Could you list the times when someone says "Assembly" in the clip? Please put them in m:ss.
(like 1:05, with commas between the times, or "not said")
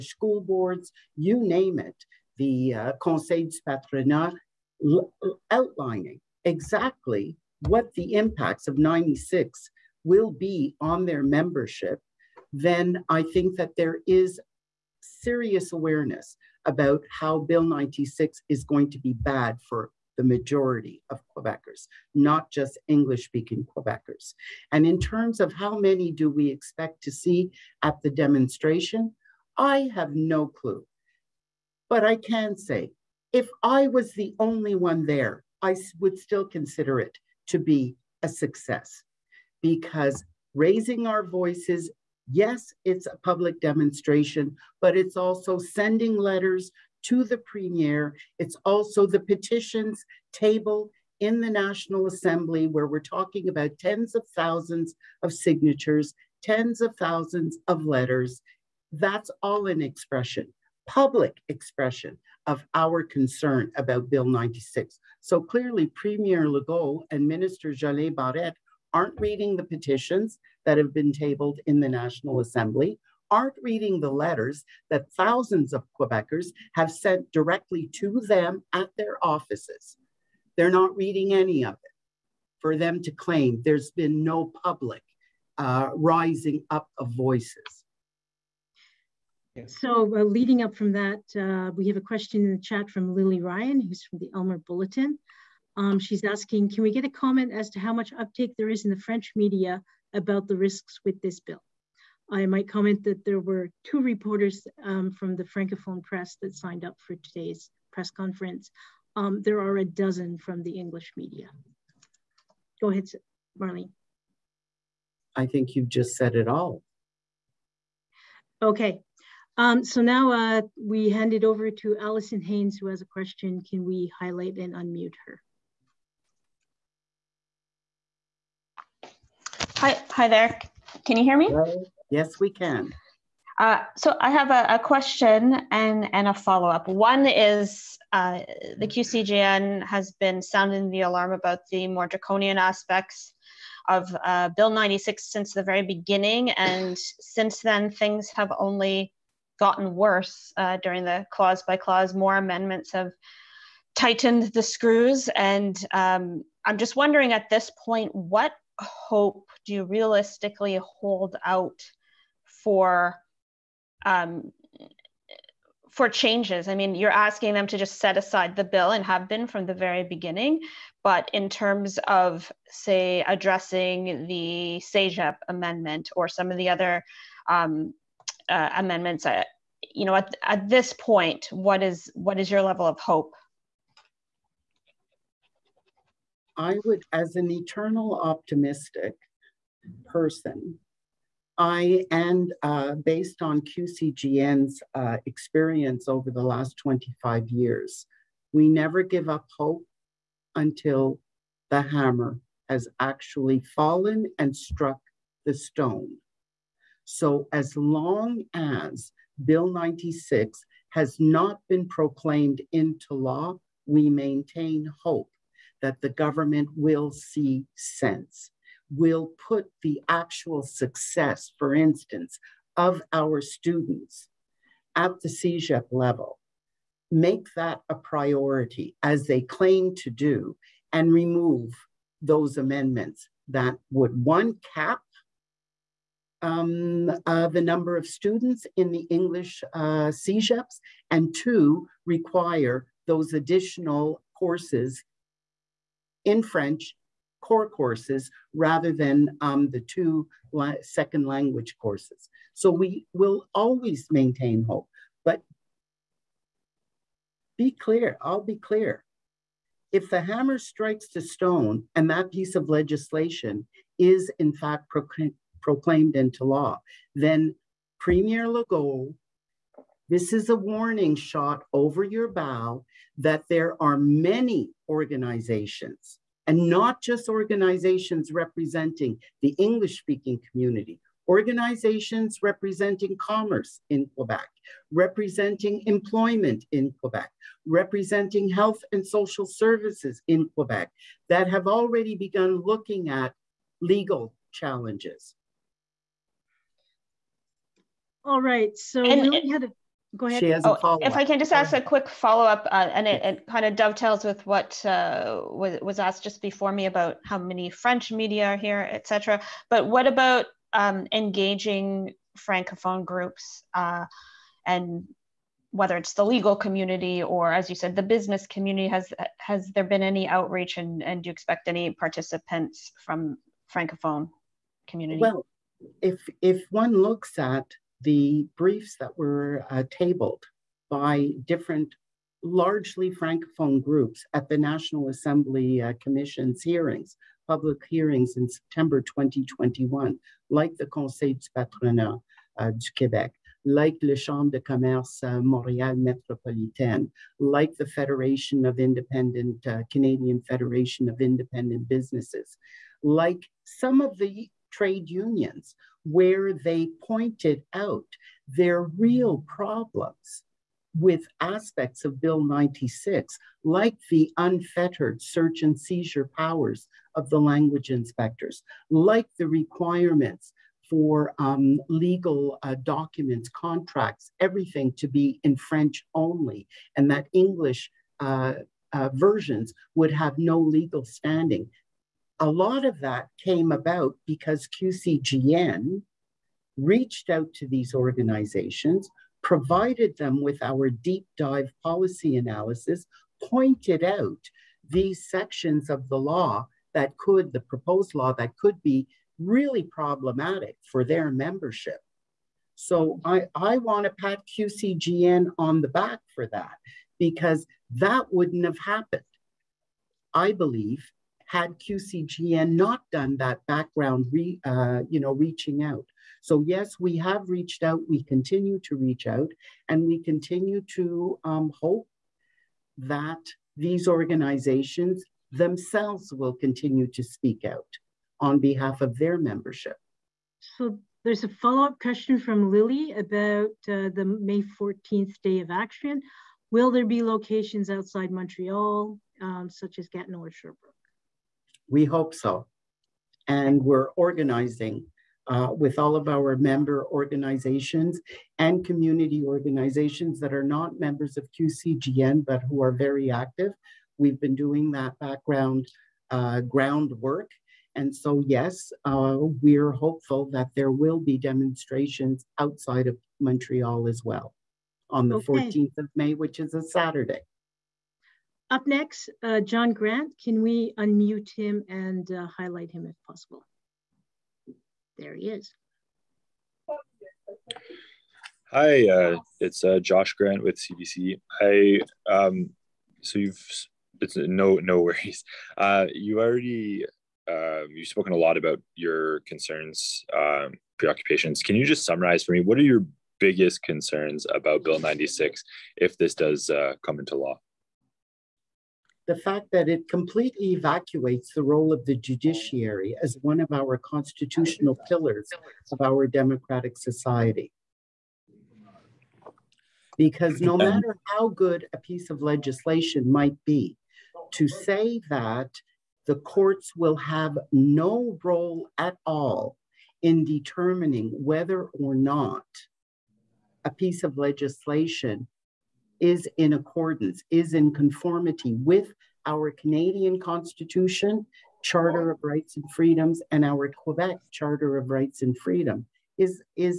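0:52, 1:12, 5:35.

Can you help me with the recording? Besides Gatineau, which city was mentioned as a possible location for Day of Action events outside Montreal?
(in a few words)
Sherbrooke.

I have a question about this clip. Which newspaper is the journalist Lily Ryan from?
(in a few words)
Aylmer Bulletin.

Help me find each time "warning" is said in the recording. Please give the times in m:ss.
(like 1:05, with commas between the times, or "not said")
4:30.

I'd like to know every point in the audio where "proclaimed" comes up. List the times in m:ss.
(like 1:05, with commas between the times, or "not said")
3:31, 4:25.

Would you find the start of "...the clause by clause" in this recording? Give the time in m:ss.
2:31.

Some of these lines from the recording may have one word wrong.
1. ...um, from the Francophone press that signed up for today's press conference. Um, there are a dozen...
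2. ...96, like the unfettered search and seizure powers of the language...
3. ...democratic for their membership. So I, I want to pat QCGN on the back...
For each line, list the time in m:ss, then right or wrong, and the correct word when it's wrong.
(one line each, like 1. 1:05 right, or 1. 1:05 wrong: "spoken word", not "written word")
1. 1:44 right
2. 6:02 right
3. 6:39 wrong: "problematic", not "democratic".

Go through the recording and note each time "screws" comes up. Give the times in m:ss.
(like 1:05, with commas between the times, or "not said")
2:34.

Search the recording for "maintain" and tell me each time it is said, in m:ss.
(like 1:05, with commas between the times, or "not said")
3:34, 4:14.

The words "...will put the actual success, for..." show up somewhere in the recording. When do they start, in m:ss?
3:38.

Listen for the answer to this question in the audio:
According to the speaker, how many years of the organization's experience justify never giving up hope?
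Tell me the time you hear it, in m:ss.
3:16.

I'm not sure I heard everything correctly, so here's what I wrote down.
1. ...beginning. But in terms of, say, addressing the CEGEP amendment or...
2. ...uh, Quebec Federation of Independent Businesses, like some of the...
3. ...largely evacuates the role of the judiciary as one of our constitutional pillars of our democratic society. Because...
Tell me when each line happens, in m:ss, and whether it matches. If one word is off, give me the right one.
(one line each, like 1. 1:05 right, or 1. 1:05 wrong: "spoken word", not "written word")
1. 2:50 right
2. 5:49 wrong: "Canadian", not "Quebec"
3. 8:20 wrong: "completely", not "largely".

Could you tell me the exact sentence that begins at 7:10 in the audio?
So there's a follow-up question from Lily about uh, the May 14th Day of Action.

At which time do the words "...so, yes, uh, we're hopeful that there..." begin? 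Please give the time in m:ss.
7:38.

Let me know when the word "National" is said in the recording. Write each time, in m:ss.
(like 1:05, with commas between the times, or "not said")
0:51, 1:11, 5:34.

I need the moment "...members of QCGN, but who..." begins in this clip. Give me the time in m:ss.
7:31.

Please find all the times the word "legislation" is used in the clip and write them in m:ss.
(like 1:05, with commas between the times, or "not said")
4:22, 8:32, 8:44.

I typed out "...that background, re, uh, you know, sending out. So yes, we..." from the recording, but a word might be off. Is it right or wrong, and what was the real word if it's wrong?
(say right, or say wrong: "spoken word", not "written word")
wrong: "reaching", not "sending".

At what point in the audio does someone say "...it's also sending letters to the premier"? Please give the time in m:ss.
0:44.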